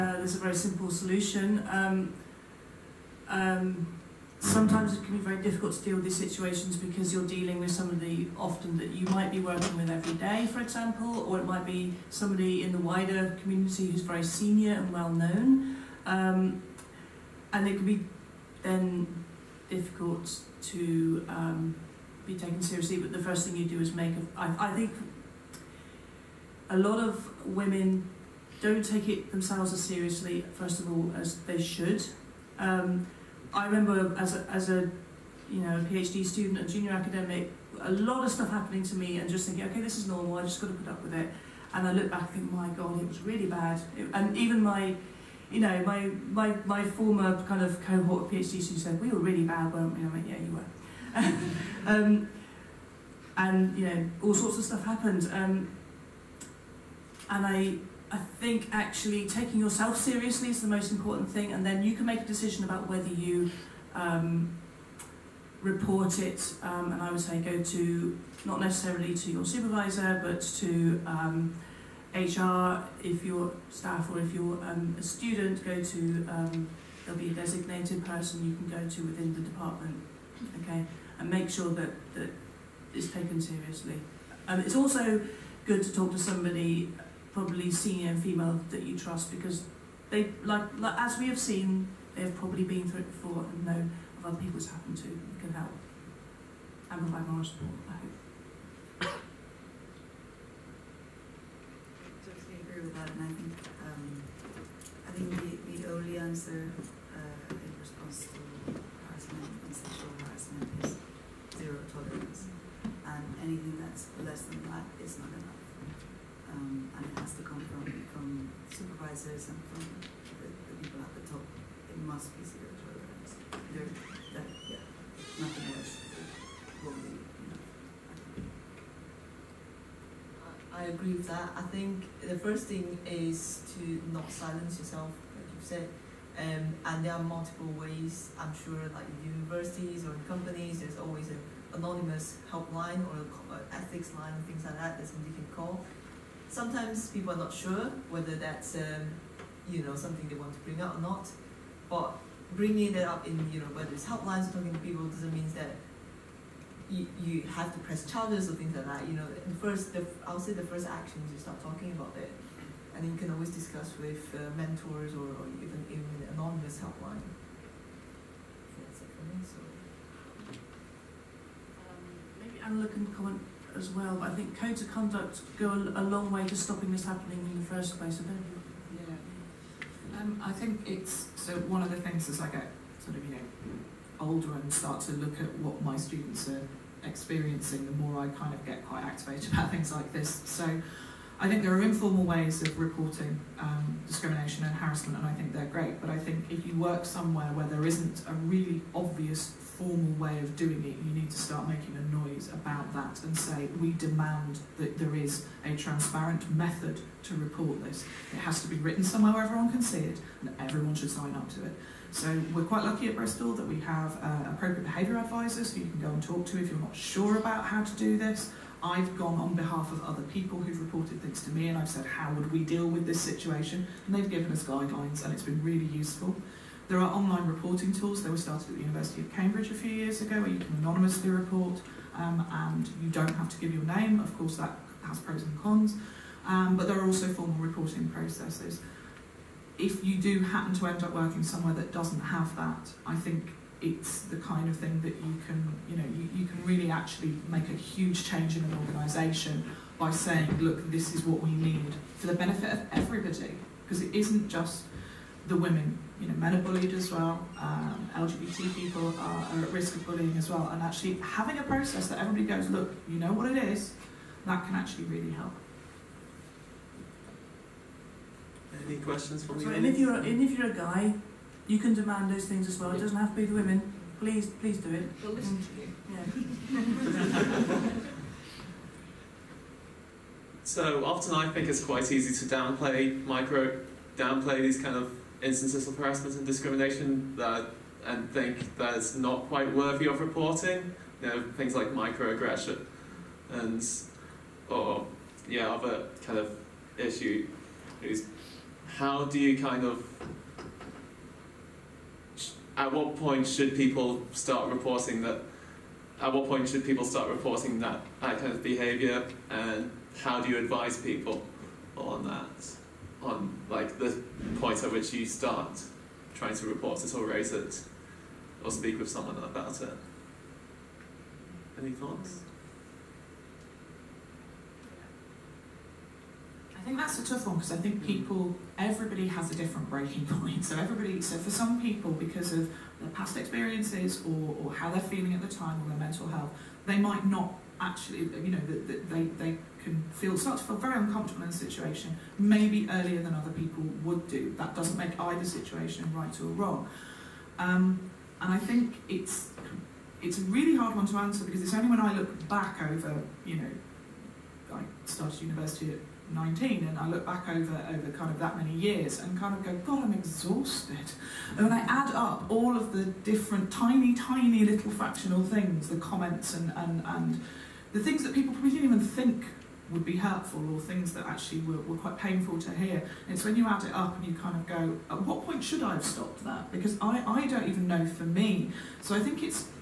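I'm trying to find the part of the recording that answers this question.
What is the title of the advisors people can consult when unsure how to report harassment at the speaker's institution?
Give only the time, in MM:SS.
03:34.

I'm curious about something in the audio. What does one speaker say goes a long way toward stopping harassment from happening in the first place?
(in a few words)
Codes of conduct.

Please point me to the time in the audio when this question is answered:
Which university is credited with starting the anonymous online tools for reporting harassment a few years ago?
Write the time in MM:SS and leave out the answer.
03:48.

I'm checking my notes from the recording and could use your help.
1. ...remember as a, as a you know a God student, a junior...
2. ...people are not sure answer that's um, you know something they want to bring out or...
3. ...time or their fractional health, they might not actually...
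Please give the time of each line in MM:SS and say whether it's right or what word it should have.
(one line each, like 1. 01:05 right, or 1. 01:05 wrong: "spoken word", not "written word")
1. 00:33 wrong: "PhD", not "God"
2. 02:27 wrong: "whether", not "answer"
3. 05:35 wrong: "mental", not "fractional".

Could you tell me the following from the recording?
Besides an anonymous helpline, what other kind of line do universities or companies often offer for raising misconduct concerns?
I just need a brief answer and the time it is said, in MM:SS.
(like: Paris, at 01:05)
Ethics line, at 02:23.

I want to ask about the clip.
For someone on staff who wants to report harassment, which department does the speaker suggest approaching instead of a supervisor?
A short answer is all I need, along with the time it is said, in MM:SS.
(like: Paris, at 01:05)
HR, at 01:12.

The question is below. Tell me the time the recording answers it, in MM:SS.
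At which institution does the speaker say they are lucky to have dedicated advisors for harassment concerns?
03:33.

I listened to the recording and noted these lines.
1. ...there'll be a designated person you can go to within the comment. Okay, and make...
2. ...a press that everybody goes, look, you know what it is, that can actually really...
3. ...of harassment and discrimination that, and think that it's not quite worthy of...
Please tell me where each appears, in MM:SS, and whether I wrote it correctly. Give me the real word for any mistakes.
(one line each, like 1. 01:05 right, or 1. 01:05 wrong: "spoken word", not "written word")
1. 01:17 wrong: "department", not "comment"
2. 04:21 wrong: "process", not "press"
3. 04:45 right.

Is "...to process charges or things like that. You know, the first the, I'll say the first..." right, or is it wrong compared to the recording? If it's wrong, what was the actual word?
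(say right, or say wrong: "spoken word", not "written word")
wrong: "press", not "process".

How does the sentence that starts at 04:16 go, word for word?
You know, men are bullied as well.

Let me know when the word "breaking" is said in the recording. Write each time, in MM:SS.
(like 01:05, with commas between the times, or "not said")
05:29.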